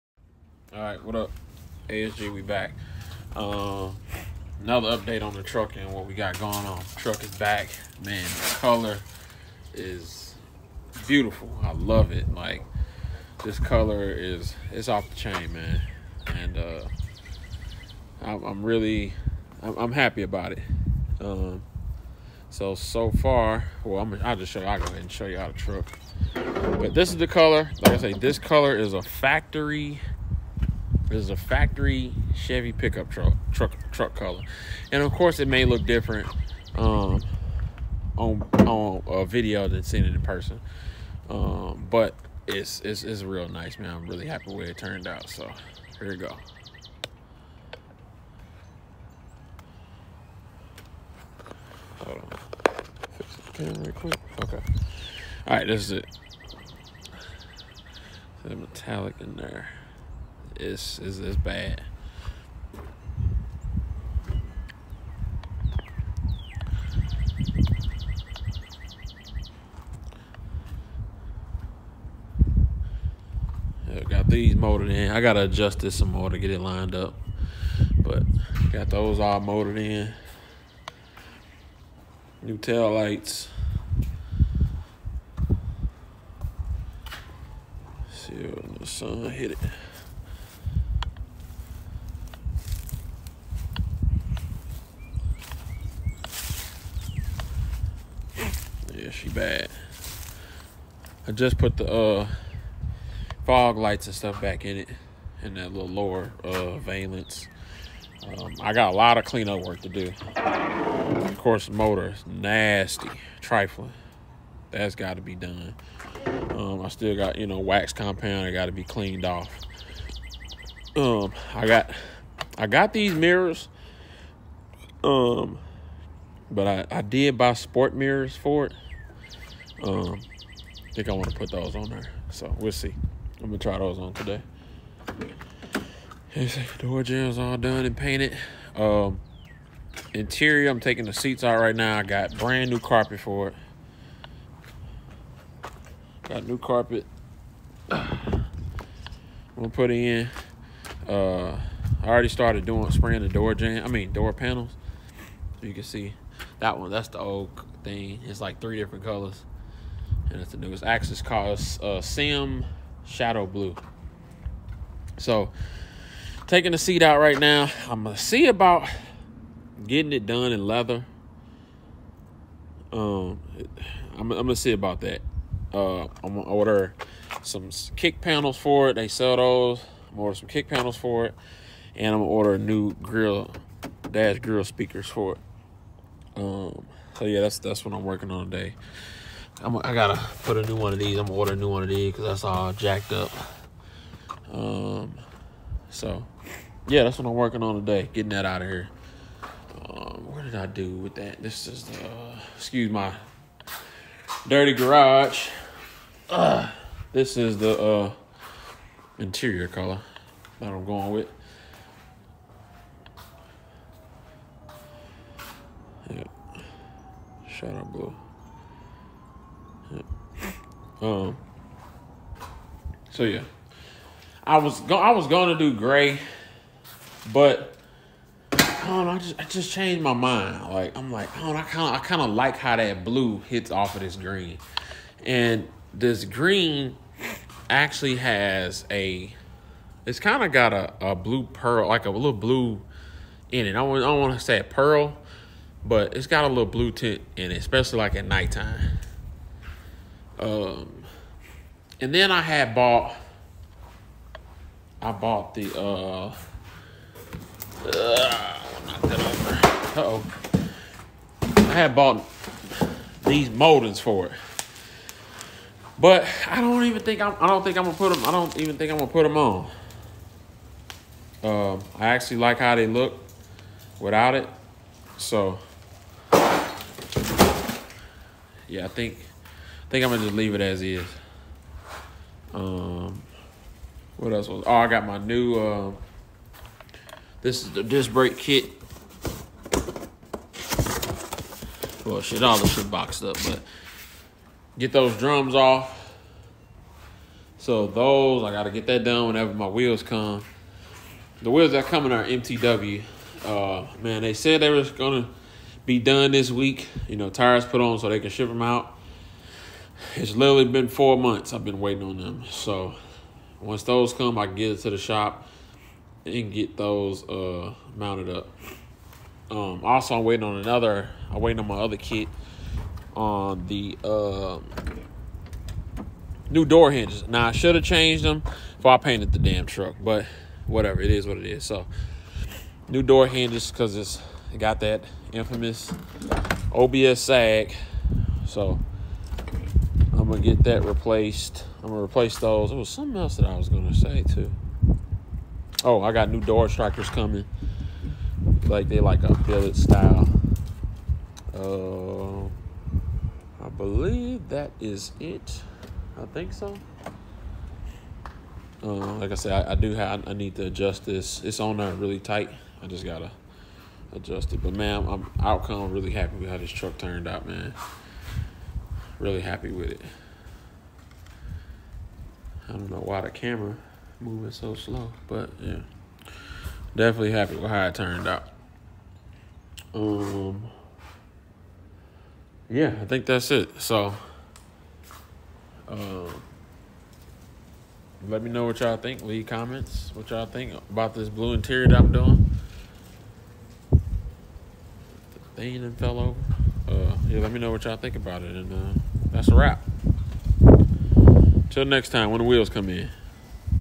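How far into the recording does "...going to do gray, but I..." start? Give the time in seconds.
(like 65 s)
225 s.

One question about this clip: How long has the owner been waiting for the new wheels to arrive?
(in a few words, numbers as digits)
4 months.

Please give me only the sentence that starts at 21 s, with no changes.
Um, so, so far, well, I'm, I'll just show you, I'll go ahead and show you how the truck.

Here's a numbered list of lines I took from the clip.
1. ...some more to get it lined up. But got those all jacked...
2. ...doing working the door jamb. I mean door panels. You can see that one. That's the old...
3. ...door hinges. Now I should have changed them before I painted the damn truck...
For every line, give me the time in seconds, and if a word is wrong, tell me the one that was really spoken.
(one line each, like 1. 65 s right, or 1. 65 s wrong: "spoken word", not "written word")
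1. 75 s wrong: "molded", not "jacked"
2. 152 s wrong: "spraying", not "working"
3. 326 s right.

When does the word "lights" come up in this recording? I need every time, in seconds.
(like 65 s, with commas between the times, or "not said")
82 s, 103 s.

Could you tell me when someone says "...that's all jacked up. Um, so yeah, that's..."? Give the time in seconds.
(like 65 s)
192 s.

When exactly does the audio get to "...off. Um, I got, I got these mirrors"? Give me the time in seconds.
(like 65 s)
119 s.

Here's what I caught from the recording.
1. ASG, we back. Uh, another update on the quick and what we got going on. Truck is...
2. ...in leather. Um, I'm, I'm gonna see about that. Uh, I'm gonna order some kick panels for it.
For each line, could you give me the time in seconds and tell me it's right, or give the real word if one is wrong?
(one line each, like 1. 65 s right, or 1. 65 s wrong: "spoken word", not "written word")
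1. 1 s wrong: "truck", not "quick"
2. 170 s right.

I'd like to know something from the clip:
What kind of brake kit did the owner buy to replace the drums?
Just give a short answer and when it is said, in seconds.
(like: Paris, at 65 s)
disc brake kit, at 287 s.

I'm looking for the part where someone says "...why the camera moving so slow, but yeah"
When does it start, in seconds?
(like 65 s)
373 s.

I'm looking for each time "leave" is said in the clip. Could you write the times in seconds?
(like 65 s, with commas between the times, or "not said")
280 s, 389 s.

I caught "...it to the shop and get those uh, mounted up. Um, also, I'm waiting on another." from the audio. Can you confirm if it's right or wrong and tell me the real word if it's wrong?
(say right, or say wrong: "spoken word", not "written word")
right.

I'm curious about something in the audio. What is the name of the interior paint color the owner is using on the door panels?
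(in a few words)
SEM Shadow Blue.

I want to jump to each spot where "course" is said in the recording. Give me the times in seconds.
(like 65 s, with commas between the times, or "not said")
35 s, 111 s.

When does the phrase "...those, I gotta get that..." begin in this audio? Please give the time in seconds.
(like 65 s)
297 s.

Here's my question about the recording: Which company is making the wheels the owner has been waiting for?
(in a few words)
MTW.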